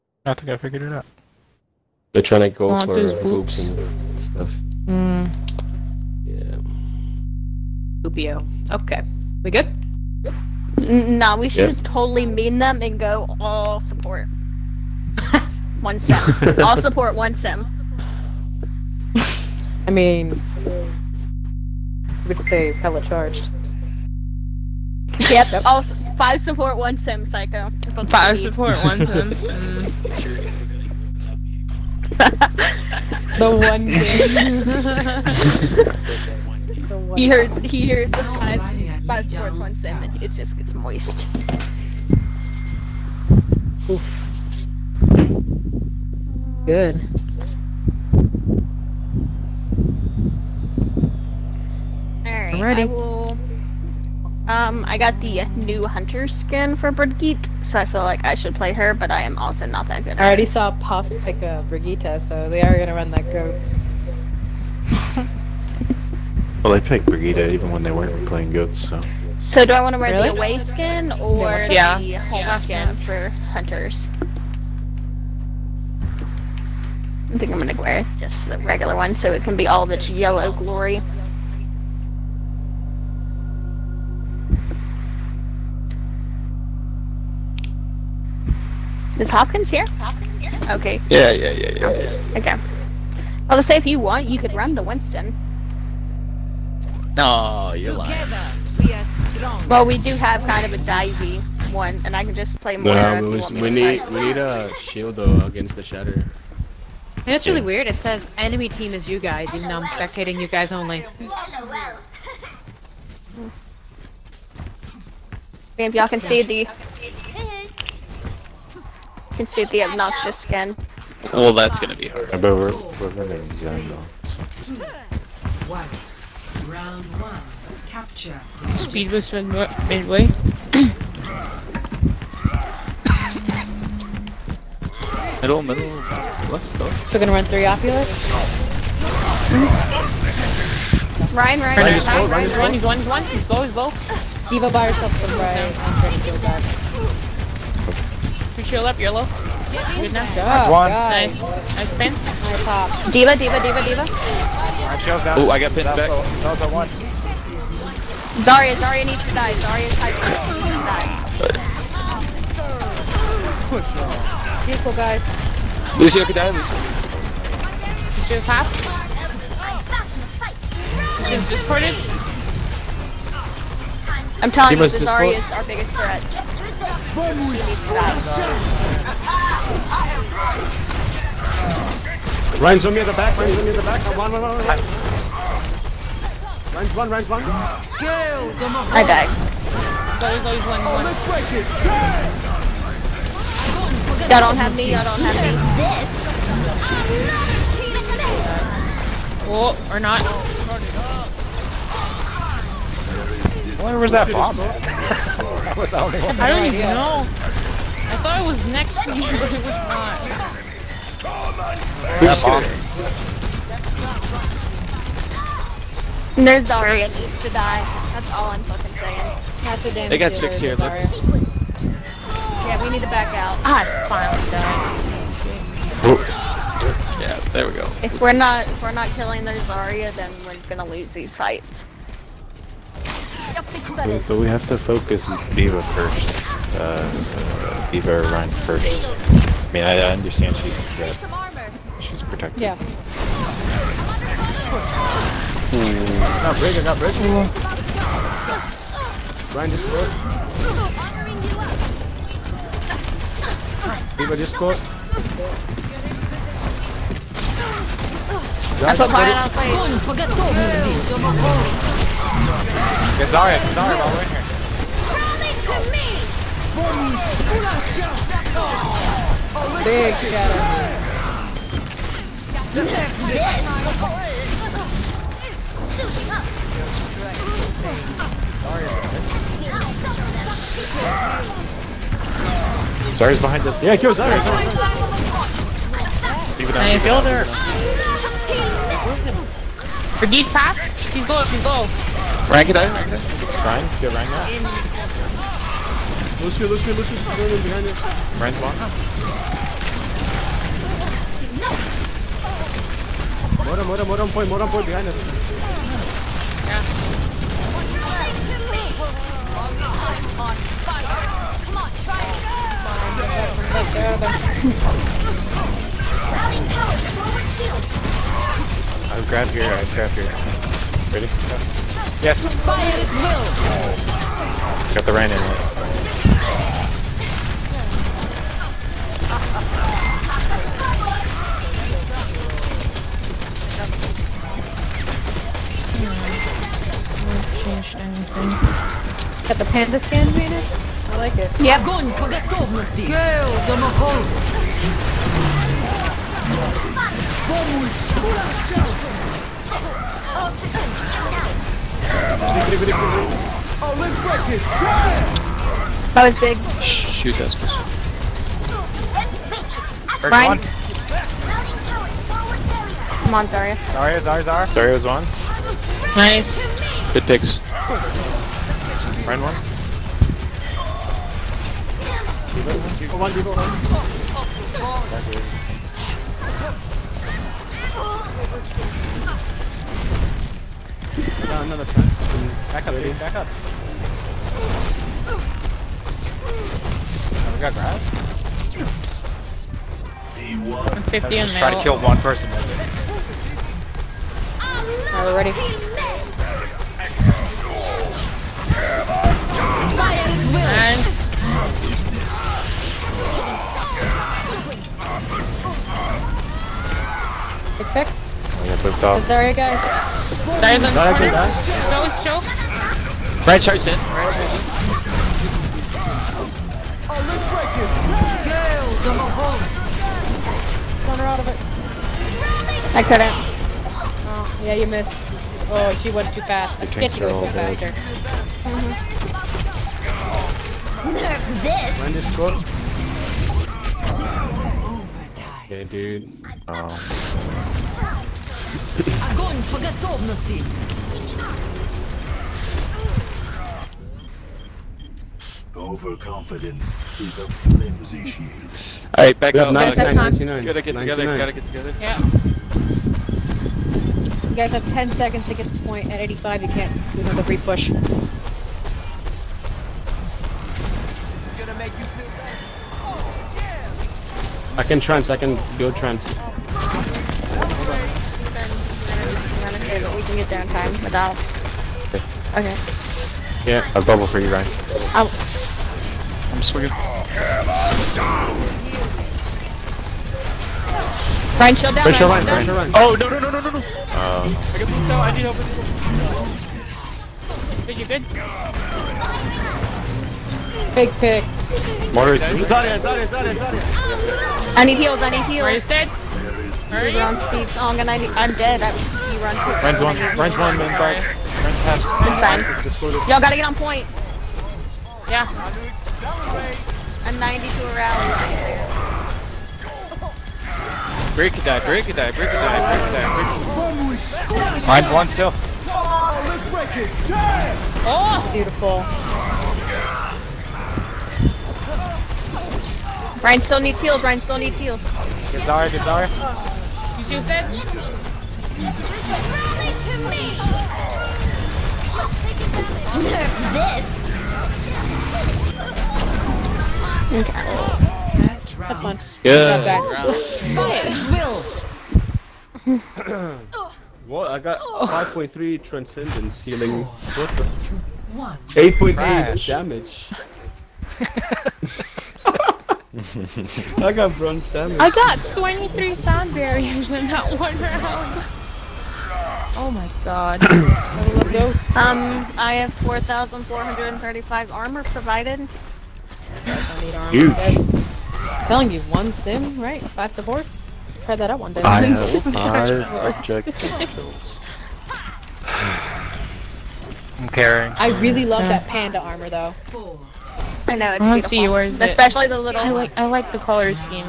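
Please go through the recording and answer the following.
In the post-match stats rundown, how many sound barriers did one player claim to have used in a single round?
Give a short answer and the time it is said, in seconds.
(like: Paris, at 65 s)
23, at 555 s.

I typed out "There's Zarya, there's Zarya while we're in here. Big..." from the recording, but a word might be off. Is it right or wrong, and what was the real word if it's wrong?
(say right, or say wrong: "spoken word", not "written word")
right.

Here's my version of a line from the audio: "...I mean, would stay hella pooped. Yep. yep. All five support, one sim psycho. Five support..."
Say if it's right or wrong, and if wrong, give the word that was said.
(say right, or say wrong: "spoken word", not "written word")
wrong: "charged", not "pooped".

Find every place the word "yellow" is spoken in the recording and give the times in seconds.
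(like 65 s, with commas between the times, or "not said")
80 s, 148 s.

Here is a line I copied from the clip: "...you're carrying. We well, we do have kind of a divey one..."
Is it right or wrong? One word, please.
wrong.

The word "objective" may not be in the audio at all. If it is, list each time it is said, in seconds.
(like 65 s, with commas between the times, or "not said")
573 s.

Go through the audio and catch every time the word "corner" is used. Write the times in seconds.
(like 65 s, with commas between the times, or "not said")
410 s, 421 s.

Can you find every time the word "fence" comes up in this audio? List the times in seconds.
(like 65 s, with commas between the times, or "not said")
381 s.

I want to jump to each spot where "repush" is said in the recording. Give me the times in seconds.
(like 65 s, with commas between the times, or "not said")
457 s.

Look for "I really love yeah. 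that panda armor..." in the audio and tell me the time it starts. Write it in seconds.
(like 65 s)
577 s.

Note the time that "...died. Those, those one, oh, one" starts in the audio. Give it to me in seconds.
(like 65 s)
189 s.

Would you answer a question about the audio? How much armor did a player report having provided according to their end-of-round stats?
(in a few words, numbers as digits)
4,435.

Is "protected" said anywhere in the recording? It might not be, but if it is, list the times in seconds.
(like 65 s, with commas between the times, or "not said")
242 s.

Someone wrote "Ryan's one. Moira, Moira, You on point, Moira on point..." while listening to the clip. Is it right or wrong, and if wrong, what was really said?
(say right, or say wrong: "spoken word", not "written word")
wrong: "Moira", not "You".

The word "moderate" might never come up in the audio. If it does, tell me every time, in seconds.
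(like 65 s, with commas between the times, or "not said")
not said.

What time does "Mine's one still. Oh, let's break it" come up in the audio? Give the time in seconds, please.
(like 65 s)
514 s.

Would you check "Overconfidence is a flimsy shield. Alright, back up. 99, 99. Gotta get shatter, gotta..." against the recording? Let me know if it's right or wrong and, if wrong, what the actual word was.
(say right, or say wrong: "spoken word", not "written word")
wrong: "together", not "shatter".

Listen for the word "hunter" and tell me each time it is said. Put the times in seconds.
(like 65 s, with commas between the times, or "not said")
55 s, 73 s.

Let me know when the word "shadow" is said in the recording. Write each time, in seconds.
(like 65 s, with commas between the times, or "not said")
270 s.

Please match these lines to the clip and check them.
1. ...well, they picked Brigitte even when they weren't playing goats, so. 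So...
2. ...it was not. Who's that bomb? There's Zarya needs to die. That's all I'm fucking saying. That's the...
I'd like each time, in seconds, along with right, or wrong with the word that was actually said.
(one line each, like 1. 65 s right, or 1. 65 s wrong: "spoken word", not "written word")
1. 66 s right
2. 209 s right.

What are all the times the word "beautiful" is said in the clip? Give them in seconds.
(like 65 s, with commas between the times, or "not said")
518 s, 581 s.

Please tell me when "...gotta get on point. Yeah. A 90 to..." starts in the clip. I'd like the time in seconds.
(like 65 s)
503 s.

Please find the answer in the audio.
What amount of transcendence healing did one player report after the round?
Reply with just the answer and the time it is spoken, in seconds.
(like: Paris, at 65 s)
5.3, at 544 s.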